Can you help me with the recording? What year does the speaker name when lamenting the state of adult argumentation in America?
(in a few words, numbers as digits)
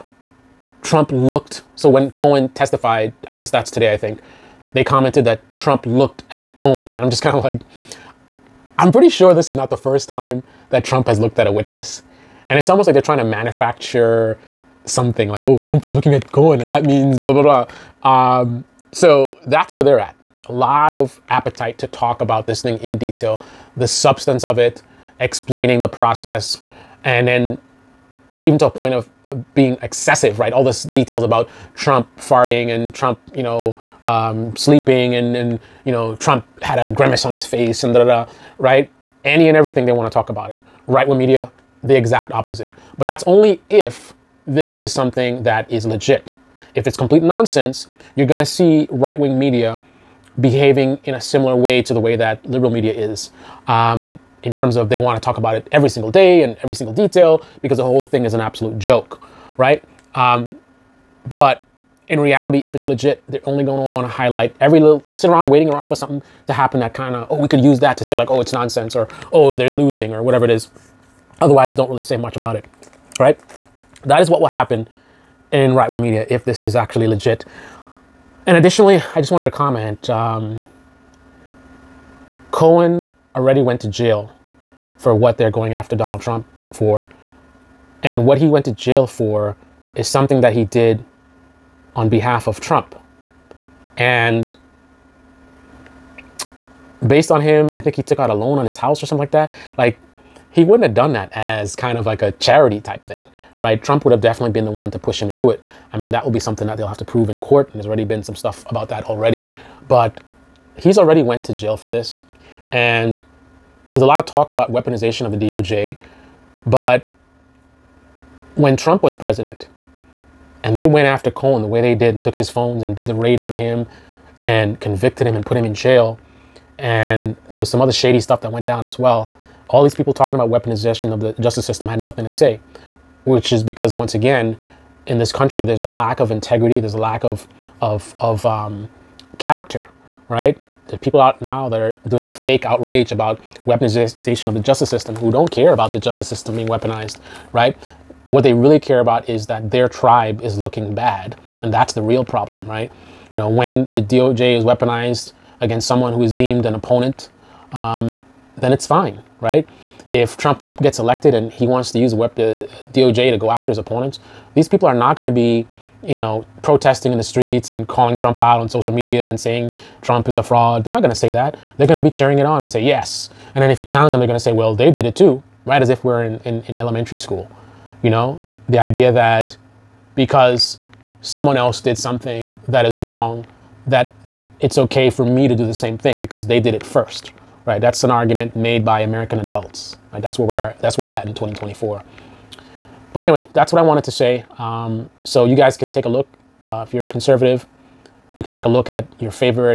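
2024.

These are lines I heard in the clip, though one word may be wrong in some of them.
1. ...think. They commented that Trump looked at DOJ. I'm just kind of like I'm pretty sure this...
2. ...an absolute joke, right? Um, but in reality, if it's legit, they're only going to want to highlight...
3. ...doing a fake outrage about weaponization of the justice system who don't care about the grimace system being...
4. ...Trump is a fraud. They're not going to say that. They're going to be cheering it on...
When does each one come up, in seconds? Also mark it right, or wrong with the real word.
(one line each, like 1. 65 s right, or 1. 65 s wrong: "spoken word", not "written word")
1. 3 s wrong: "Cohen", not "DOJ"
2. 58 s right
3. 142 s wrong: "justice", not "grimace"
4. 170 s right.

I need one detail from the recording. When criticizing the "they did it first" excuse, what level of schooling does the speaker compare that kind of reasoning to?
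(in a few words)
elementary school.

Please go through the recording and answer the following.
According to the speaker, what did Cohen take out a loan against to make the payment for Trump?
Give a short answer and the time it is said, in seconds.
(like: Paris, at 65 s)
his house, at 98 s.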